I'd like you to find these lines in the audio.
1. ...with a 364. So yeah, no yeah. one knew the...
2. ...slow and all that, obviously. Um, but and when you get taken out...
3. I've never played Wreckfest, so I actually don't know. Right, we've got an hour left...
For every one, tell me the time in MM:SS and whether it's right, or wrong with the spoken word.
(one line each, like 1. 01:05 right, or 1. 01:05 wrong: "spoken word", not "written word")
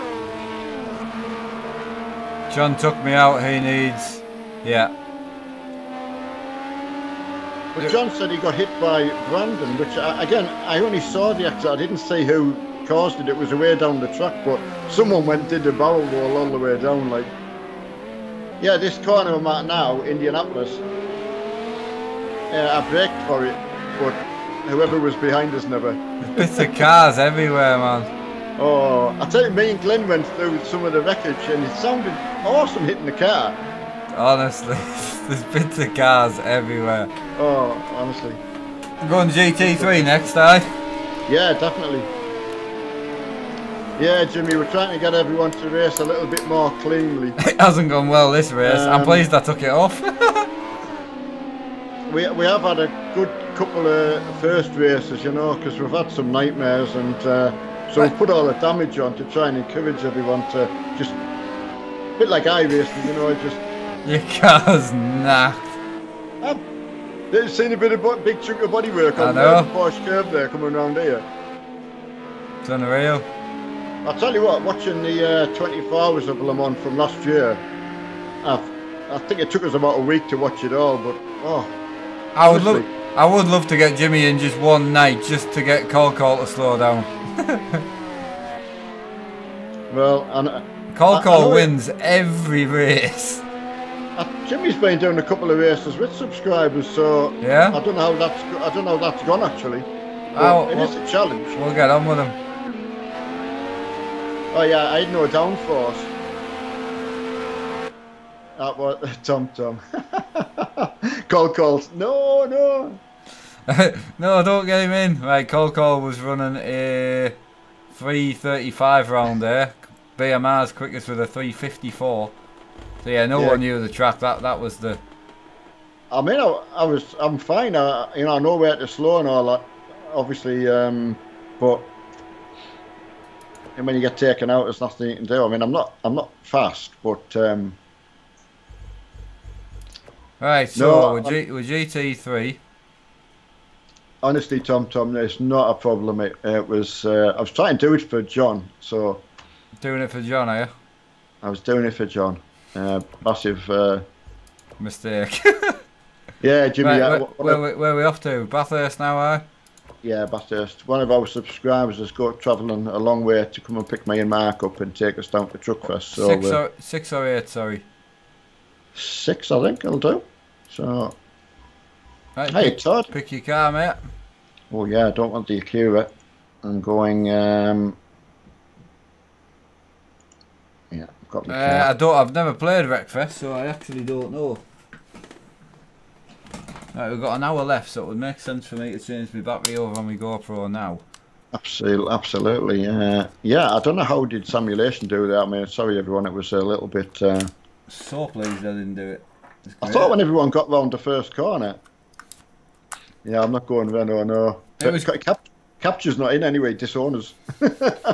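1. 02:01 wrong: "354", not "364"
2. 02:08 right
3. 03:02 right.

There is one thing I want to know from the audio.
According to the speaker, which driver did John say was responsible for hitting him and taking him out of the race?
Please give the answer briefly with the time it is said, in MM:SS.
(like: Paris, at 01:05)
Brandon, at 00:09.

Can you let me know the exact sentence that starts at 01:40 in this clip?
Oh, it well, is a challenge.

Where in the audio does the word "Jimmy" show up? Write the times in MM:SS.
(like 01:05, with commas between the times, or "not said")
00:44, 01:23, 01:34, 02:36.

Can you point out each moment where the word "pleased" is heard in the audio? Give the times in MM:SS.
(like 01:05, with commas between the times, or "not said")
00:49, 03:18.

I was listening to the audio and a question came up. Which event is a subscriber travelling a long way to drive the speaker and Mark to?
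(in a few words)
Truckfest.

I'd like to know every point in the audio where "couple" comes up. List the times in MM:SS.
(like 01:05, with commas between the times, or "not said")
00:53, 01:35.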